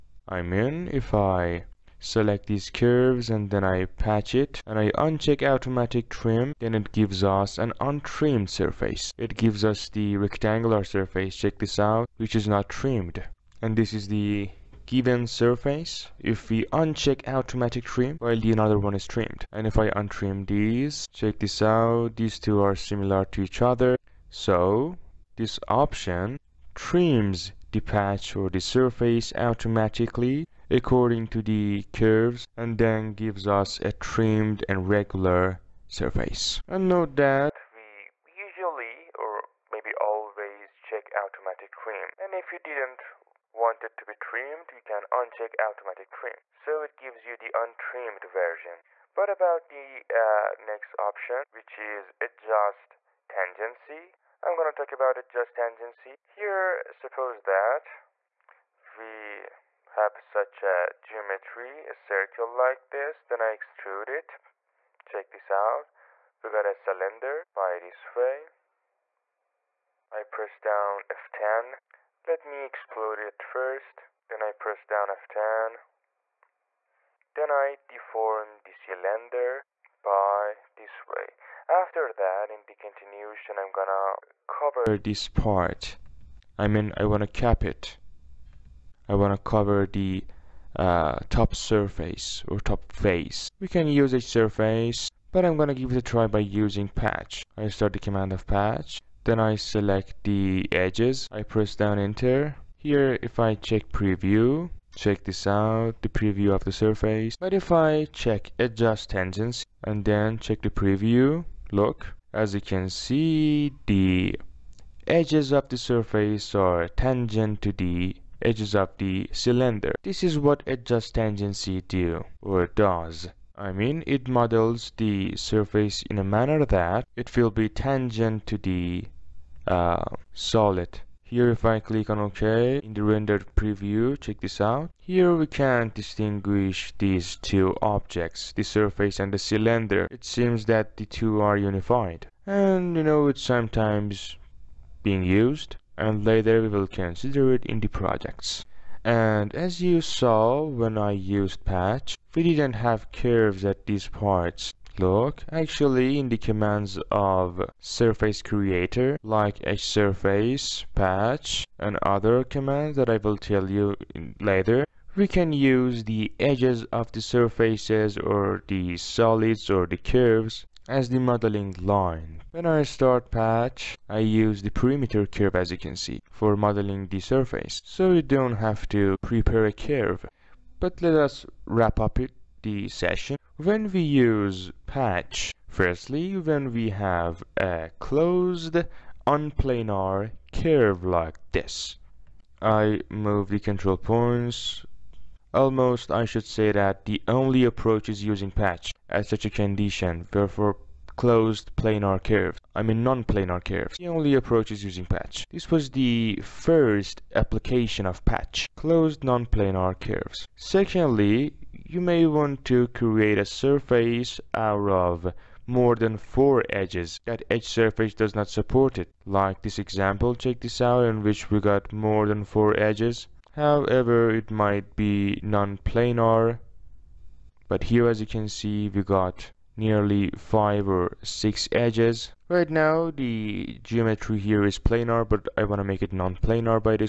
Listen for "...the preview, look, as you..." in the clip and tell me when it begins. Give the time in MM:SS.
01:50.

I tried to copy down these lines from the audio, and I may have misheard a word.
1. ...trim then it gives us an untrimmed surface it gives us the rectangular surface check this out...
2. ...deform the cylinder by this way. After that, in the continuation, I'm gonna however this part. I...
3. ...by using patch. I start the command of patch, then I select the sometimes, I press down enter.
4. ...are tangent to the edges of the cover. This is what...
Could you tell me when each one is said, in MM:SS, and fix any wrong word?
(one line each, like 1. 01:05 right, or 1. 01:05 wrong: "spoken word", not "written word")
1. 00:06 right
2. 01:17 wrong: "cover", not "however"
3. 01:36 wrong: "edges", not "sometimes"
4. 01:56 wrong: "cylinder", not "cover".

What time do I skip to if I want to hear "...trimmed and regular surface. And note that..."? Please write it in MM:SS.
00:33.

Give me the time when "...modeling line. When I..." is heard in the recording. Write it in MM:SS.
02:51.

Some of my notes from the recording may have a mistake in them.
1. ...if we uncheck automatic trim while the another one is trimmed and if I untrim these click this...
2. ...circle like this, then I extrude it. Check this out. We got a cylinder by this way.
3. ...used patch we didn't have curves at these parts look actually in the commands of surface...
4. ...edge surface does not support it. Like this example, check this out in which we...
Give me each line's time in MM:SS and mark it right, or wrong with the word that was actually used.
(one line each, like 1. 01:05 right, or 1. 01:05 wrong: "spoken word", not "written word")
1. 00:16 wrong: "check", not "click"
2. 01:01 right
3. 02:31 right
4. 03:37 right.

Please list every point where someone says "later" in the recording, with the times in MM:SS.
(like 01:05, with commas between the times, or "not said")
02:26, 02:44.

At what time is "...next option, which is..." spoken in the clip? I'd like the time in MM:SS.
00:50.